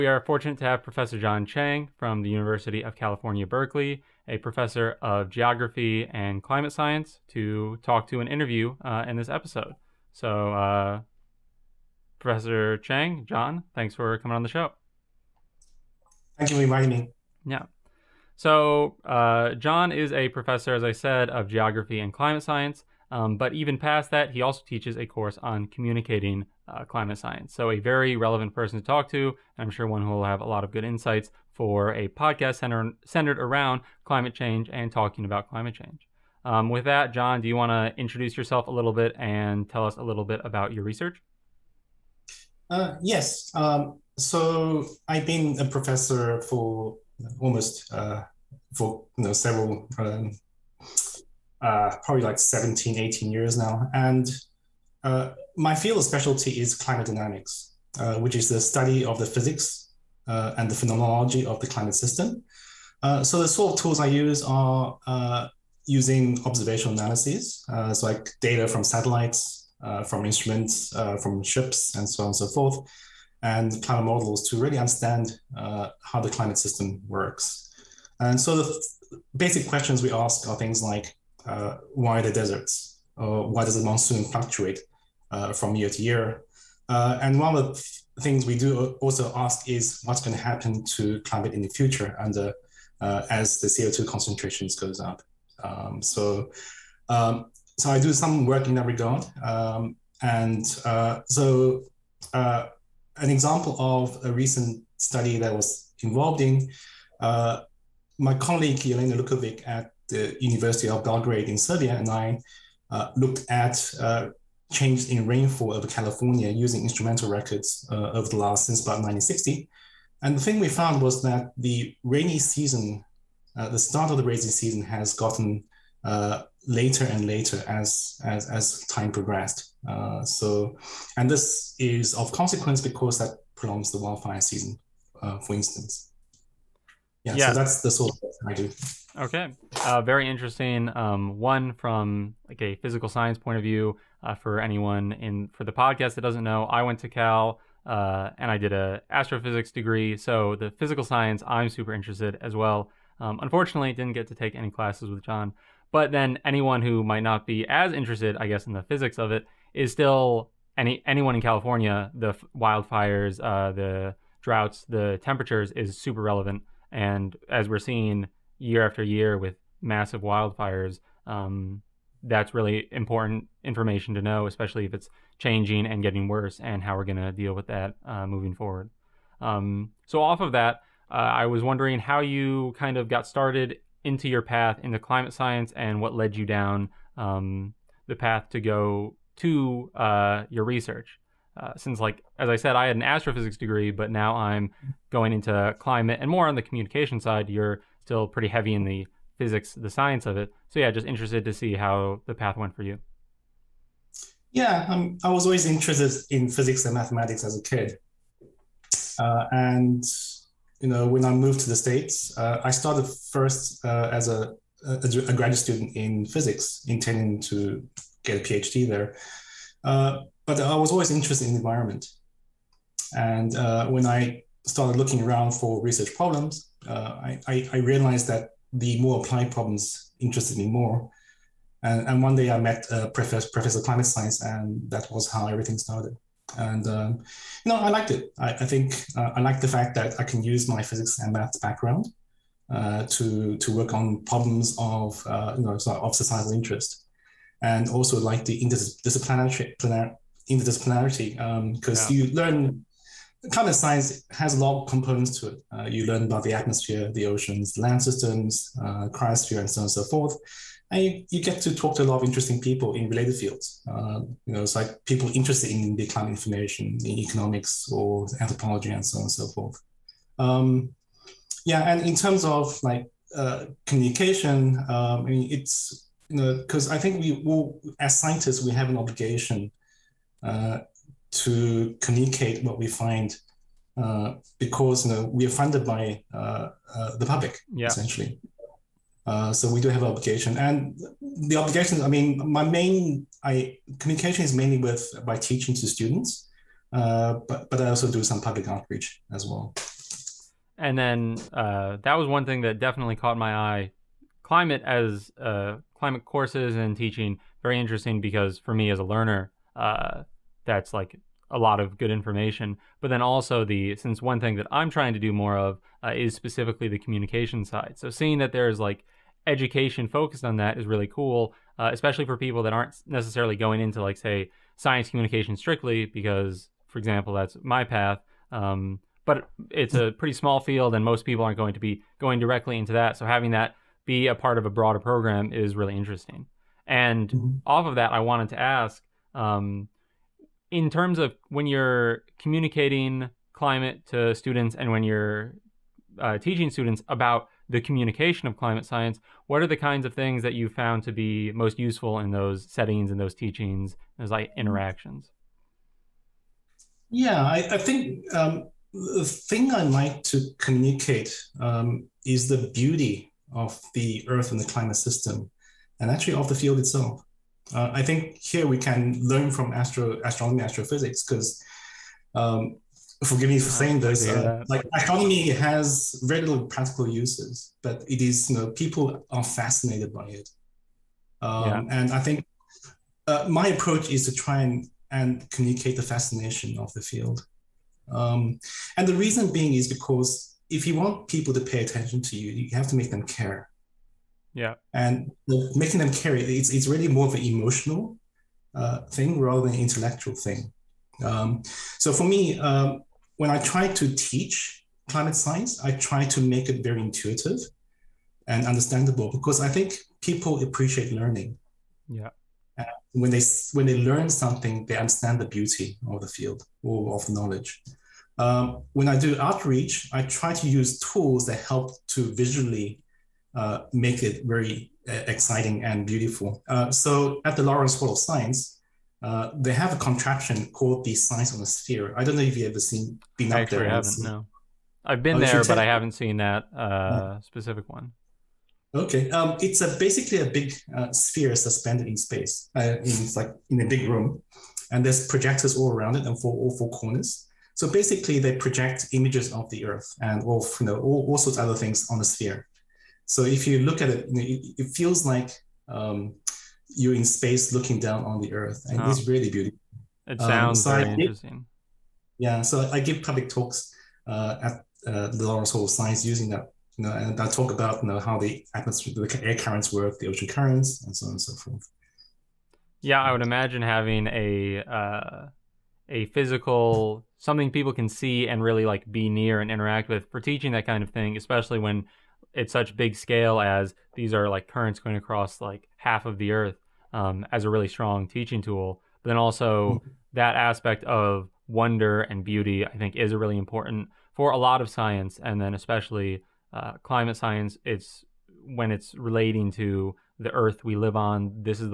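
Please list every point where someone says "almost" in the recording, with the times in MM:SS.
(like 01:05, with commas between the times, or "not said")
00:47.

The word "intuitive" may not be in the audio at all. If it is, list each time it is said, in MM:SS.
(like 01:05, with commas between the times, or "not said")
06:47.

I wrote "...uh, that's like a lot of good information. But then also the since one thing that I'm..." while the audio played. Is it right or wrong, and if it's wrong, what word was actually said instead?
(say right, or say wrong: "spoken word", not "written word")
right.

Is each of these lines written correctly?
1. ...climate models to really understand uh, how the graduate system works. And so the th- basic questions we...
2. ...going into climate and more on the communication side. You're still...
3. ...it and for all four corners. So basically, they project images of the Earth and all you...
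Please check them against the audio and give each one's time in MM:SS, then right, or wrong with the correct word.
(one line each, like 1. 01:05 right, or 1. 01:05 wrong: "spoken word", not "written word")
1. 01:13 wrong: "climate", not "graduate"
2. 03:15 right
3. 07:26 right.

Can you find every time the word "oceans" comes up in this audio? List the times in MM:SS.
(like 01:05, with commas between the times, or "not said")
04:17, 07:50.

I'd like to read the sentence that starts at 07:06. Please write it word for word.
Uh, so at the Lawrence School of Science, uh, they have a contraption called the Science on a Sphere.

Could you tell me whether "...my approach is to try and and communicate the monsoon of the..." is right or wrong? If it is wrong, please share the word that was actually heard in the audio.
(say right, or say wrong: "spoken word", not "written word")
wrong: "fascination", not "monsoon".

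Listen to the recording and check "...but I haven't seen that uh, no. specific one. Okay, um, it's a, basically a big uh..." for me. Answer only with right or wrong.
right.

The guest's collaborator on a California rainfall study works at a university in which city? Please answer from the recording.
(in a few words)
Belgrade.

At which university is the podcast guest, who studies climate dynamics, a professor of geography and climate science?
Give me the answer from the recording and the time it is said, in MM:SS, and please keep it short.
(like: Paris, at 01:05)
University of California, Berkeley, at 00:02.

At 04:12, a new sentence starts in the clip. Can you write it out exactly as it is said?
you learn climate science has a lot of components to it.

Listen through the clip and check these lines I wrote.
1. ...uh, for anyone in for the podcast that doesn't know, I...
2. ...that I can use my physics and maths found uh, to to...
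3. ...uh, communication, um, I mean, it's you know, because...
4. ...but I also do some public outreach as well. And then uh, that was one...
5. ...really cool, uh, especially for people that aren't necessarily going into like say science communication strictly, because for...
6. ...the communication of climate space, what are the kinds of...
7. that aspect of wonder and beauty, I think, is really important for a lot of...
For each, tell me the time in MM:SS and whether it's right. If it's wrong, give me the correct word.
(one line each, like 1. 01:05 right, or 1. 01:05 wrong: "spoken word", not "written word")
1. 02:24 right
2. 03:59 wrong: "background", not "found"
3. 04:33 right
4. 04:57 right
5. 05:20 right
6. 05:47 wrong: "science", not "space"
7. 08:10 right.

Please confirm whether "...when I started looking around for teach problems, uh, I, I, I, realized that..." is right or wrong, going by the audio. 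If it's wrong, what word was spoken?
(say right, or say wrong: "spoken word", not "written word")
wrong: "research", not "teach".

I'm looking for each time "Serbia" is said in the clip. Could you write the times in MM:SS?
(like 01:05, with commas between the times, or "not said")
01:51.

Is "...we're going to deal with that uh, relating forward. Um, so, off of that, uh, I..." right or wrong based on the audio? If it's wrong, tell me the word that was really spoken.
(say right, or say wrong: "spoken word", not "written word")
wrong: "moving", not "relating".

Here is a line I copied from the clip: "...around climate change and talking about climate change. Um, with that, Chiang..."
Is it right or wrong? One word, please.
wrong.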